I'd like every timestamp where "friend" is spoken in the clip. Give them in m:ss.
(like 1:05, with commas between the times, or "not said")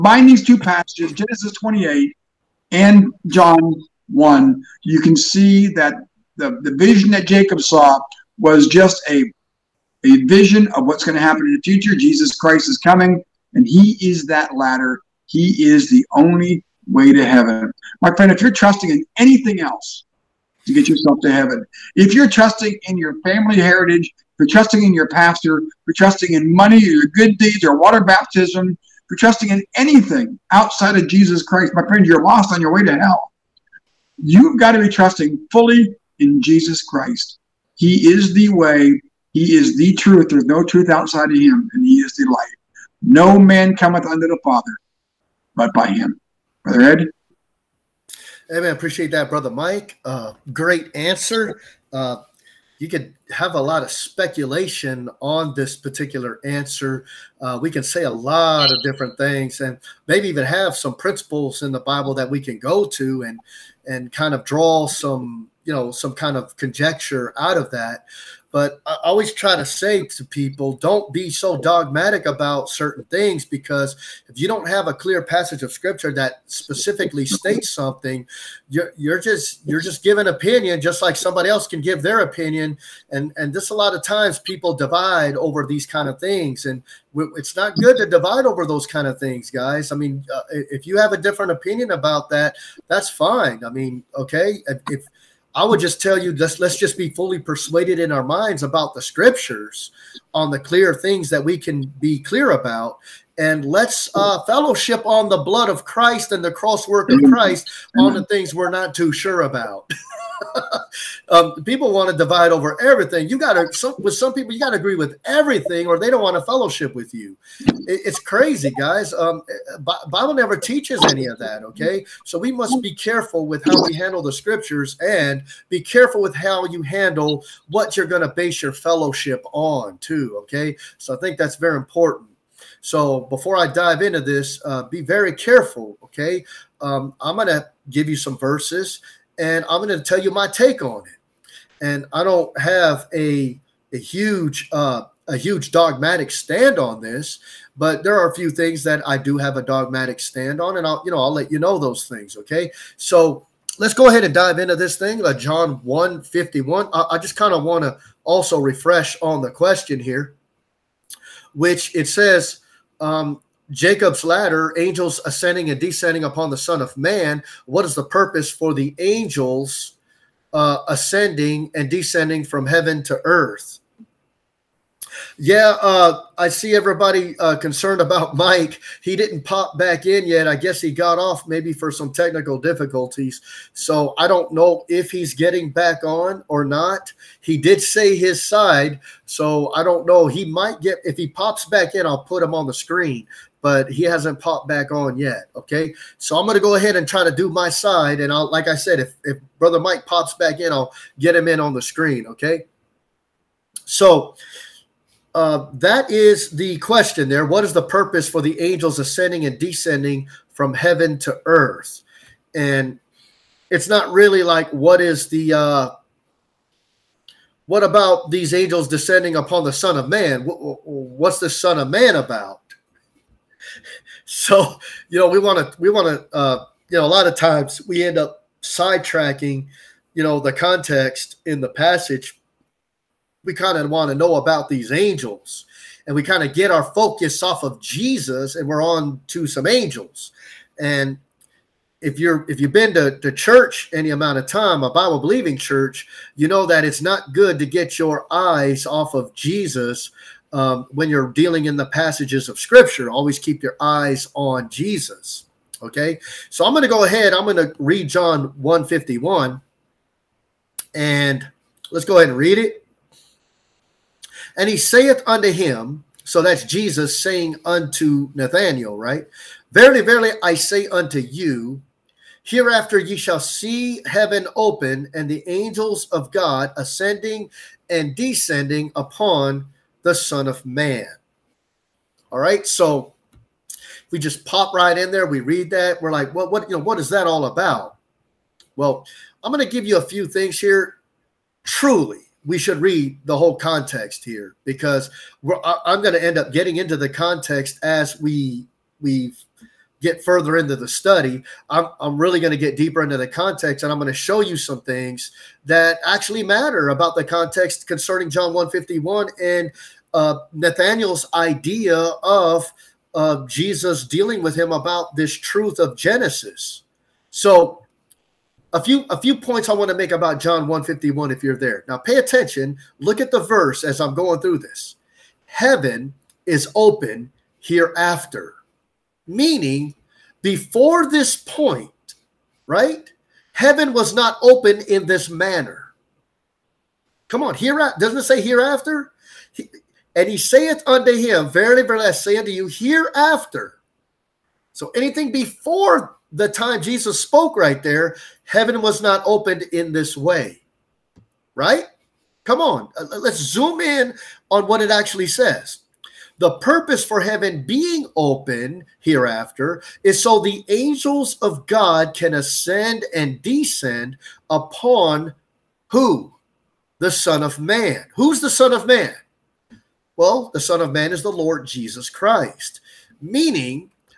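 0:18, 0:31.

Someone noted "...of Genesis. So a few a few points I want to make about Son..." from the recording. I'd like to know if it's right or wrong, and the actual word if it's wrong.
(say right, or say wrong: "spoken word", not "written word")
wrong: "John", not "Son".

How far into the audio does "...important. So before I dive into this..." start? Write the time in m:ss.
2:11.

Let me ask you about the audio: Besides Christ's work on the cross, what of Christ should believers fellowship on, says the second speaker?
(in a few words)
The blood of Christ.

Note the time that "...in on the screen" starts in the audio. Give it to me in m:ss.
3:21.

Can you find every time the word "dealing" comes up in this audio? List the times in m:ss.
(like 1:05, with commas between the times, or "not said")
4:11, 5:14.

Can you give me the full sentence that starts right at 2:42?
Um, Jacob's ladder, angels ascending and descending upon the Son of Man.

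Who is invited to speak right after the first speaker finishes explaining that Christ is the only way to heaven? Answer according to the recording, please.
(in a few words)
Brother Ed.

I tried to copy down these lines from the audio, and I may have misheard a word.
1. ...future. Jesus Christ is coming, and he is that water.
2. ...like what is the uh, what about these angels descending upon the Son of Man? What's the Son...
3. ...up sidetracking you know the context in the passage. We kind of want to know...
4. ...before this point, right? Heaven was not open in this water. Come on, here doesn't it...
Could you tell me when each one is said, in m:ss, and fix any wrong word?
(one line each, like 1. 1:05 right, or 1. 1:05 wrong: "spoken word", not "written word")
1. 0:11 wrong: "ladder", not "water"
2. 3:34 right
3. 3:48 right
4. 5:30 wrong: "manner", not "water".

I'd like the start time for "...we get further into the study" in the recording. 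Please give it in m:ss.
4:59.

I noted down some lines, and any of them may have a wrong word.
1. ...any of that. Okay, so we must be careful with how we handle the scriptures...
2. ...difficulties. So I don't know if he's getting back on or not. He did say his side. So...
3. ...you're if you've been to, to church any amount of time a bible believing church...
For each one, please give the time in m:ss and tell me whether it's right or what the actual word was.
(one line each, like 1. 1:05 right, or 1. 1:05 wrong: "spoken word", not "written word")
1. 2:01 right
2. 3:02 right
3. 4:02 right.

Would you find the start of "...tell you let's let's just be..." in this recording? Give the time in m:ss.
1:35.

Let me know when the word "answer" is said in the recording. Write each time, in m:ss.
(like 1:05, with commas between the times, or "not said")
0:50, 0:56.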